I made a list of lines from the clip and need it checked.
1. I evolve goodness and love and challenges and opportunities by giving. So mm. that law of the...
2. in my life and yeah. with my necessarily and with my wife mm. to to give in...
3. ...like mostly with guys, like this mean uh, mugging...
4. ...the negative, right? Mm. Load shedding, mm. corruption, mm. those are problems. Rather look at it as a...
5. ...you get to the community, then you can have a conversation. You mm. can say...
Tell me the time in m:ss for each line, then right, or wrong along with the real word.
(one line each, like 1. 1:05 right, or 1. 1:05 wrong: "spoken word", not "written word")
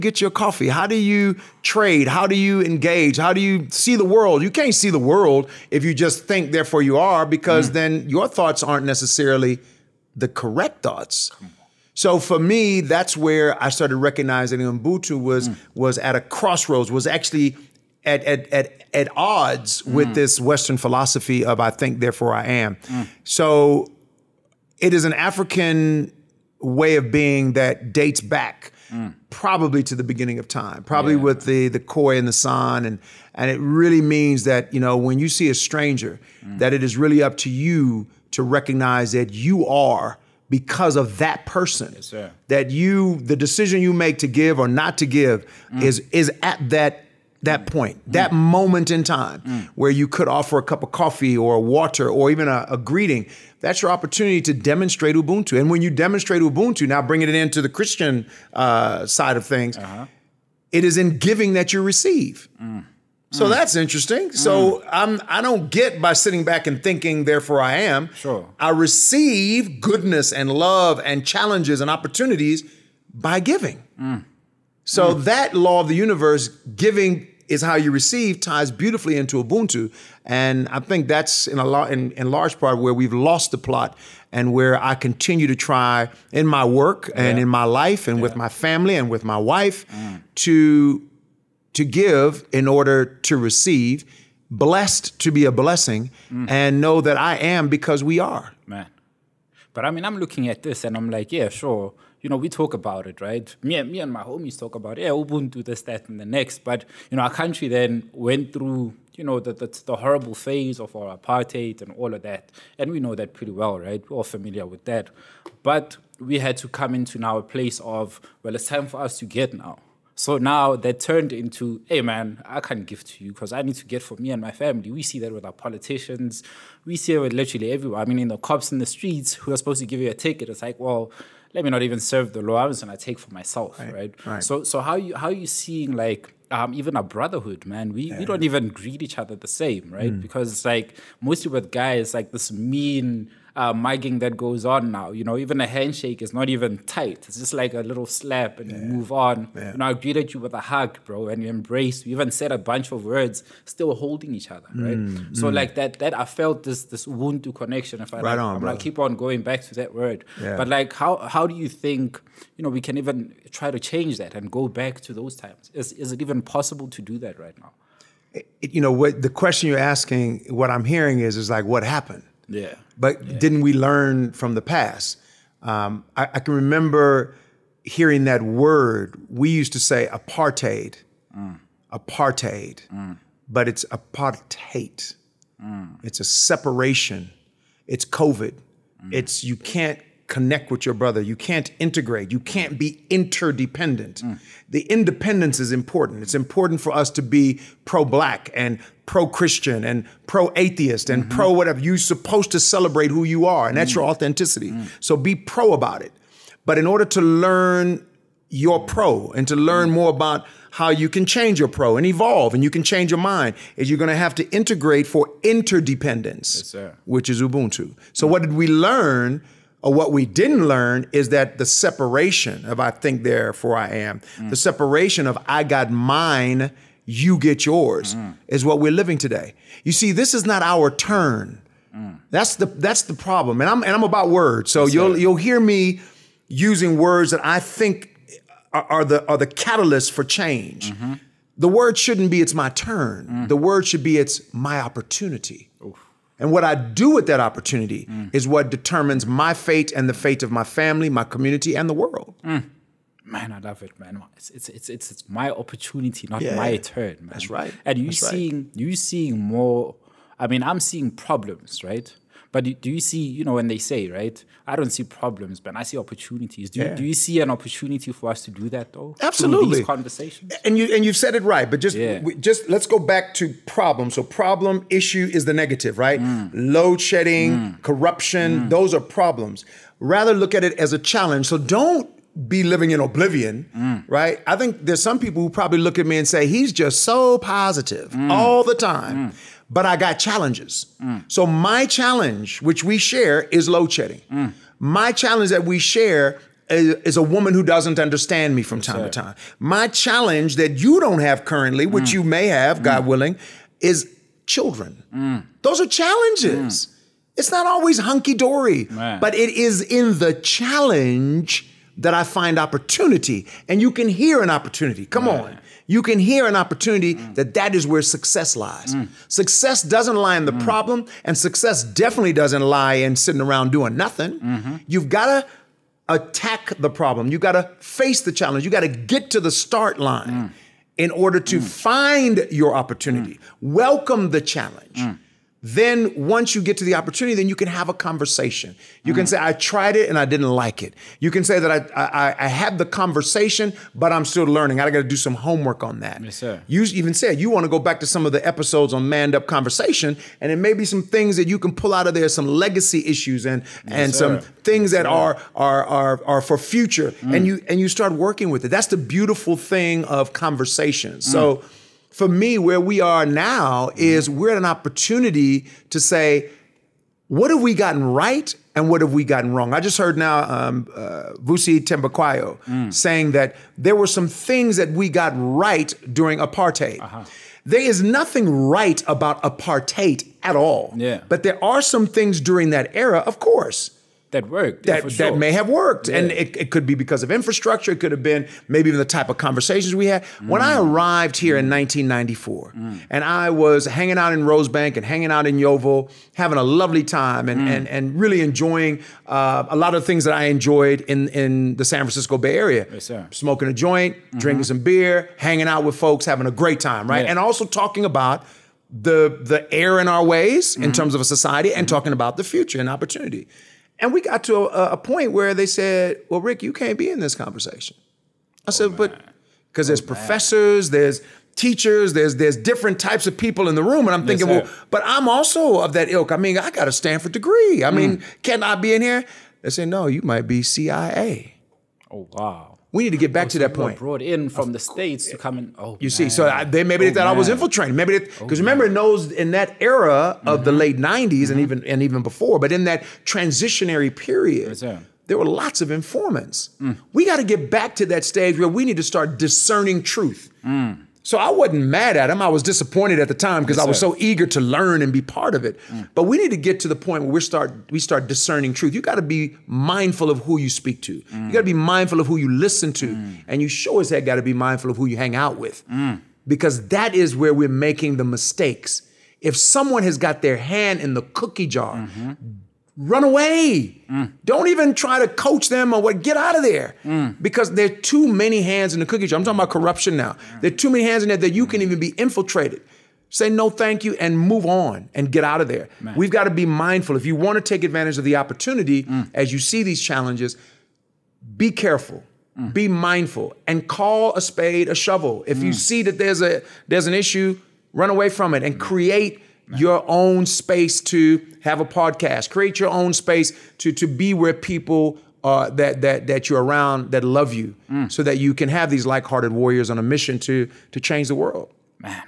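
1. 1:08 wrong: "receive", not "evolve"
2. 1:27 wrong: "family", not "necessarily"
3. 2:20 right
4. 4:35 right
5. 5:36 wrong: "opportunity", not "community".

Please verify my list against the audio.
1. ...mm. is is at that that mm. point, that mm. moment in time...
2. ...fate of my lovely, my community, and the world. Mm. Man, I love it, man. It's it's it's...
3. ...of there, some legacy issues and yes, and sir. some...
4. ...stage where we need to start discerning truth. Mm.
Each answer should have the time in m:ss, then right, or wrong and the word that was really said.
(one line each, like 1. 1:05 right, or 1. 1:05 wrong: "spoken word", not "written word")
1. 0:45 right
2. 4:10 wrong: "family", not "lovely"
3. 5:52 right
4. 7:28 right.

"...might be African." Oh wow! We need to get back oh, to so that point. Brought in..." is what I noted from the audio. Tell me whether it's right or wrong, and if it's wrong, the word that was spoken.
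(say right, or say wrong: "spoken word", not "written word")
wrong: "CIA", not "African".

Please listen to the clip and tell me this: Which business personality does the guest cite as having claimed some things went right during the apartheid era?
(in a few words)
Vusi Thembekwayo.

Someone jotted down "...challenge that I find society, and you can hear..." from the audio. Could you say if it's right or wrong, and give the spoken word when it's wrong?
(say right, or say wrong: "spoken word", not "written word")
wrong: "opportunity", not "society".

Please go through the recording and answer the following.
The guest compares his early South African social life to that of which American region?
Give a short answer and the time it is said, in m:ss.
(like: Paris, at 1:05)
San Francisco Bay Area, at 6:41.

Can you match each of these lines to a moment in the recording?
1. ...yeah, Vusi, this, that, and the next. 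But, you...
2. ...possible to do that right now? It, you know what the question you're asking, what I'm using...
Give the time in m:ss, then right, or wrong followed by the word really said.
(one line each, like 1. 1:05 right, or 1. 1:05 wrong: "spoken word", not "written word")
1. 1:44 wrong: "Ubuntu", not "Vusi"
2. 2:46 wrong: "hearing", not "using".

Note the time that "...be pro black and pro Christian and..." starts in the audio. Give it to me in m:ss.
3:17.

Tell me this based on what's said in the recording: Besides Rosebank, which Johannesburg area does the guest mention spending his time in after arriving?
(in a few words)
Yeoville.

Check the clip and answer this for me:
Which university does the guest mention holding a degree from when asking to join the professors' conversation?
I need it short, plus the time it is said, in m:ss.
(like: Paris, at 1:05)
Stanford, at 7:06.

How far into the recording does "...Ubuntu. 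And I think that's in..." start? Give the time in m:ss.
1:19.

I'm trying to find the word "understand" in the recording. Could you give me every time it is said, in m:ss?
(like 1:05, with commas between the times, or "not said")
4:57.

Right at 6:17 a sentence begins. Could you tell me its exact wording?
There is nothing right about apartheid at all.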